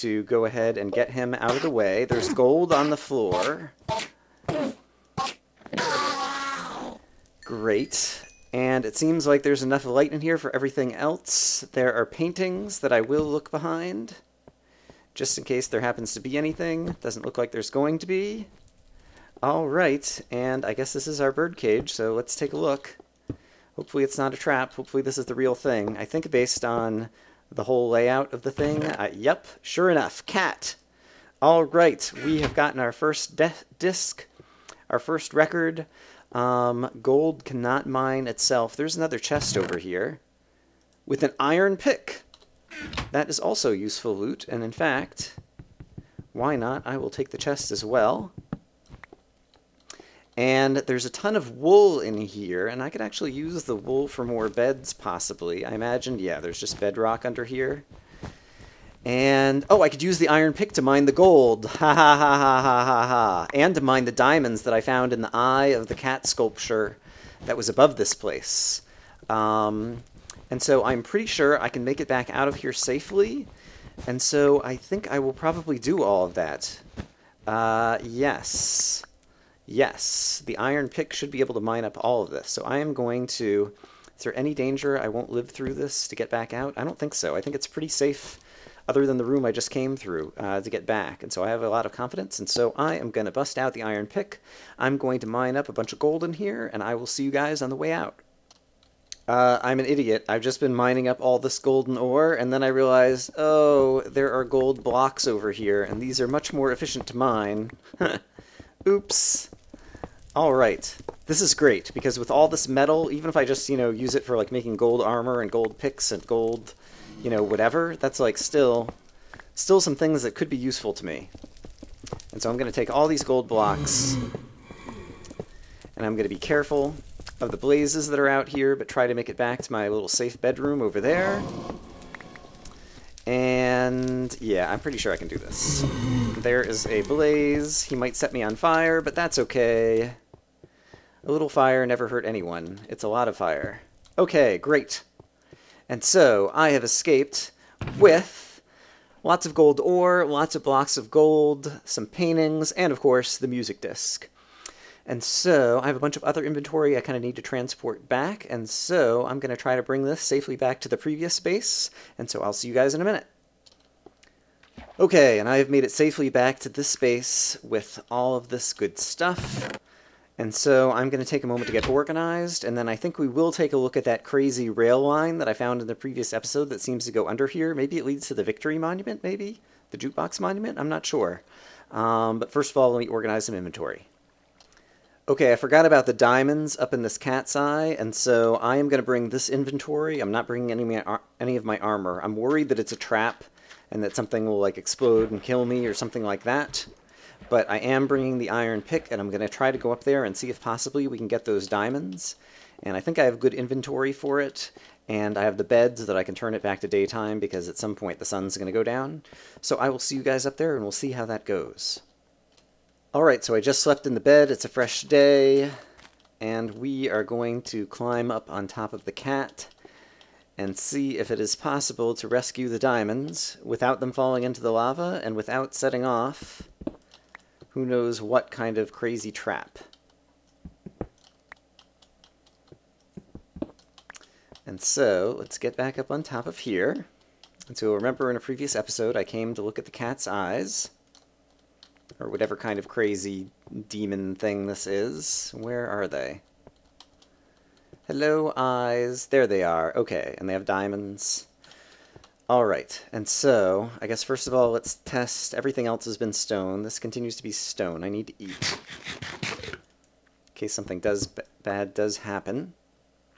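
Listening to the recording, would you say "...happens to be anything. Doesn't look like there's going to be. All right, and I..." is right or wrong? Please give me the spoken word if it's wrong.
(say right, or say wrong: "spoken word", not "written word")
right.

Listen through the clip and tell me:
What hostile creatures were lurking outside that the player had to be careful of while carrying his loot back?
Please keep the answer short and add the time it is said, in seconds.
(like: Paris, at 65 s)
blazes, at 127 s.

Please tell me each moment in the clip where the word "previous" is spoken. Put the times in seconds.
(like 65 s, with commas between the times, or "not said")
160 s, 175 s, 238 s.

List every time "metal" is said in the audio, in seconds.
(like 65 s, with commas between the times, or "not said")
112 s.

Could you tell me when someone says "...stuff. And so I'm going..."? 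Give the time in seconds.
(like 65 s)
168 s.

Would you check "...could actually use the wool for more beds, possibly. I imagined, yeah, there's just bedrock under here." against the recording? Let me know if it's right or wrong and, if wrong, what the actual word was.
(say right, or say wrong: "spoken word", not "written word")
right.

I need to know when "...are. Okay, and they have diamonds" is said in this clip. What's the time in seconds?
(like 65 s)
249 s.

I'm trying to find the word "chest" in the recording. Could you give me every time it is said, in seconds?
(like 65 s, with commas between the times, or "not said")
39 s, 47 s.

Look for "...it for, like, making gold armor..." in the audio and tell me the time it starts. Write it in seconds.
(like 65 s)
114 s.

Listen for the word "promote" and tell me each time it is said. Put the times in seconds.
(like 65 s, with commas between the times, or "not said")
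not said.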